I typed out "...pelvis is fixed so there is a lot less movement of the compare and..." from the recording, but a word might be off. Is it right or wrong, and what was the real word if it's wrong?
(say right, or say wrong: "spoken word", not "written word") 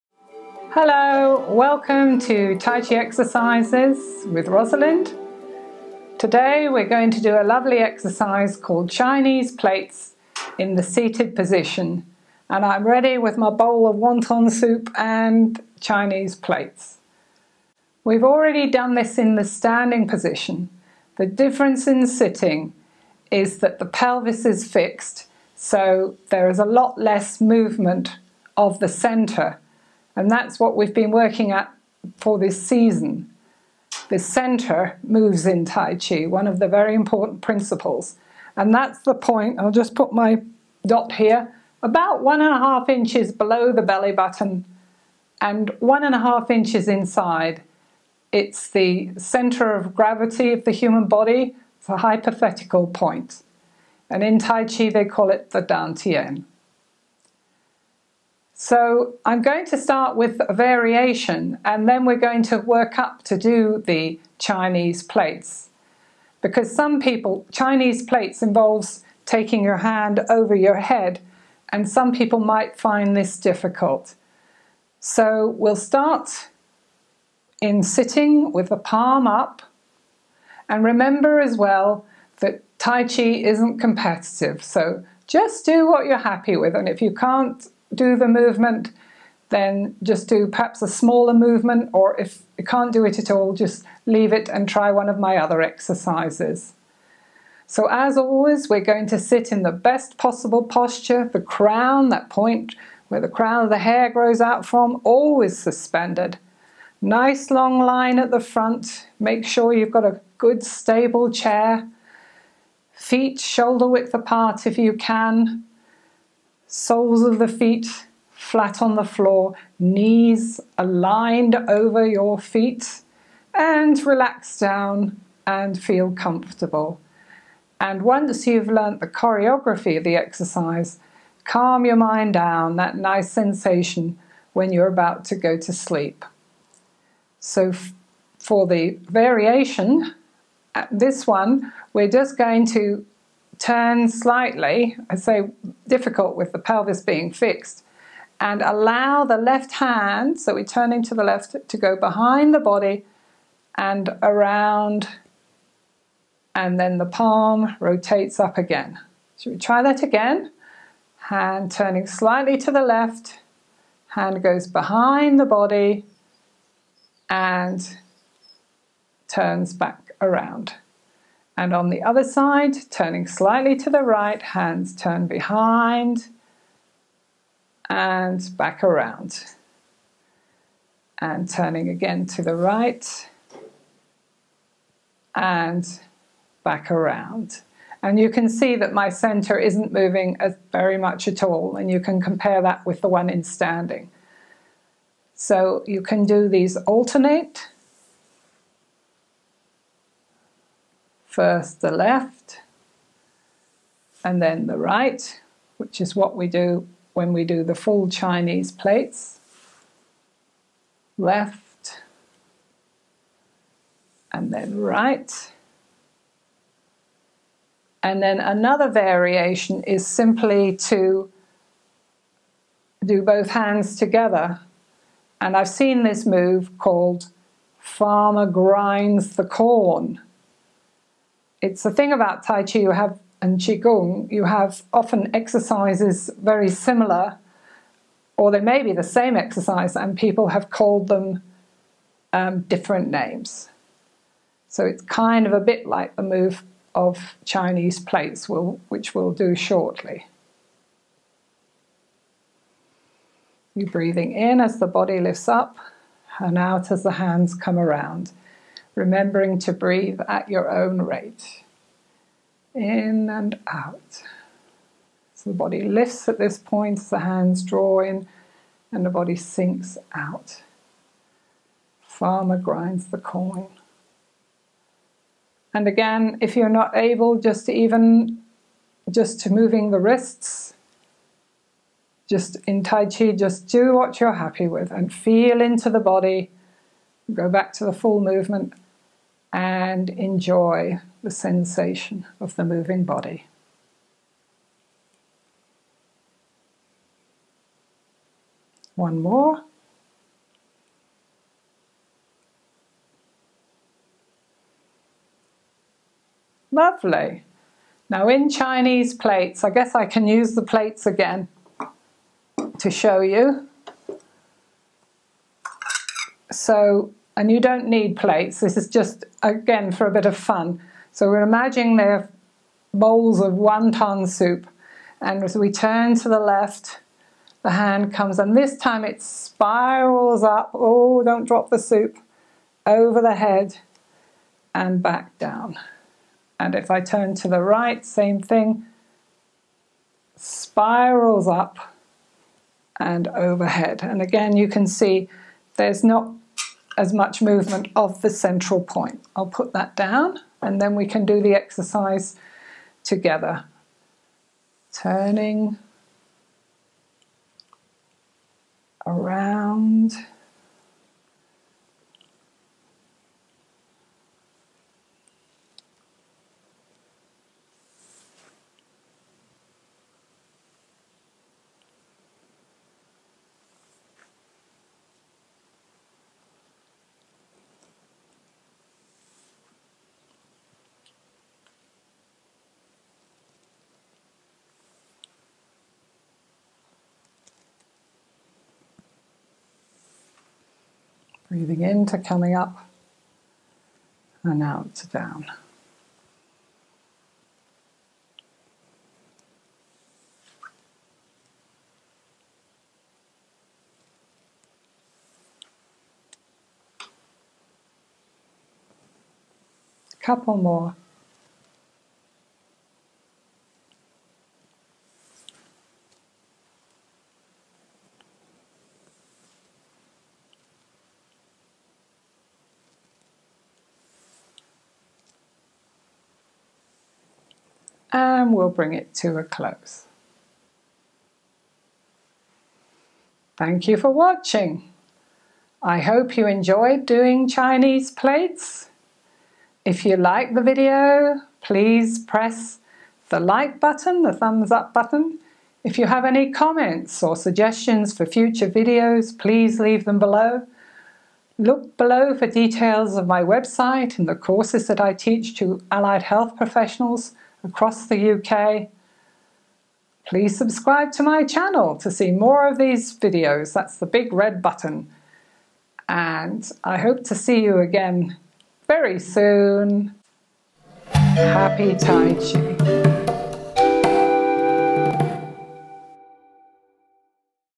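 wrong: "centre", not "compare".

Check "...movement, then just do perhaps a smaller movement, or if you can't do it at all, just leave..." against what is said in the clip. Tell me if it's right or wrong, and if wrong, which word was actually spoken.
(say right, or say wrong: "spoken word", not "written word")
right.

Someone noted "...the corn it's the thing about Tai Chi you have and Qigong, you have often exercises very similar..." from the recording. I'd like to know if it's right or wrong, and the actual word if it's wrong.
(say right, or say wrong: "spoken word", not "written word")
right.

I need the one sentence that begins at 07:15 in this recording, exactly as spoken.
I hope you enjoyed doing Chinese plates.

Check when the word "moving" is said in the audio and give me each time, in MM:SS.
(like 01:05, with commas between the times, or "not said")
03:09, 04:39, 04:52.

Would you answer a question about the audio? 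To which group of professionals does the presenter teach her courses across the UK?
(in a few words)
Allied health professionals.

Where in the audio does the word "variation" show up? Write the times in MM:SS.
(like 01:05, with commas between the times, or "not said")
01:00, 02:19, 03:38.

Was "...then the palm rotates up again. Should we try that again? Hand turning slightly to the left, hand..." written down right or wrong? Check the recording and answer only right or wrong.
right.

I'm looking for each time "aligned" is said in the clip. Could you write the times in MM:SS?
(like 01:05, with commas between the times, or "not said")
02:00.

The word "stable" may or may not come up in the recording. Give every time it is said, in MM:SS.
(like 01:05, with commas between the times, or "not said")
01:50.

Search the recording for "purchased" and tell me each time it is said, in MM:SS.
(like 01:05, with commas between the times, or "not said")
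not said.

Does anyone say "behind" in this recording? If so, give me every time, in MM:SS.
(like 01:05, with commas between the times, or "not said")
02:31, 02:44, 02:55.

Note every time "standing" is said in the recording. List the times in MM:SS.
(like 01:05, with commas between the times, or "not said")
00:19, 03:13.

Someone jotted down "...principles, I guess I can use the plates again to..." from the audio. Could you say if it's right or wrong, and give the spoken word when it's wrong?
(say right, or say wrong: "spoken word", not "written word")
wrong: "plates", not "principles".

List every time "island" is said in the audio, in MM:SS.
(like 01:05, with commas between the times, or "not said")
not said.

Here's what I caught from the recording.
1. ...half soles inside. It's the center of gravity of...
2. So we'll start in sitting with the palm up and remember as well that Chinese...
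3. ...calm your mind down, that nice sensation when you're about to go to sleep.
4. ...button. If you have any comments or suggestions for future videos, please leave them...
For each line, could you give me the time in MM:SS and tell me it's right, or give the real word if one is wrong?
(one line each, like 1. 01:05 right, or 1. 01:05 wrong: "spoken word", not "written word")
1. 00:46 wrong: "inches", not "soles"
2. 01:14 wrong: "Tai", not "Chinese"
3. 02:11 right
4. 07:24 right.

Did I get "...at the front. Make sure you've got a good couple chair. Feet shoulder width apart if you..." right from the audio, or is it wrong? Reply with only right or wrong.
wrong.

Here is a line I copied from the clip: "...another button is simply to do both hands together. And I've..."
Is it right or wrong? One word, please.
wrong.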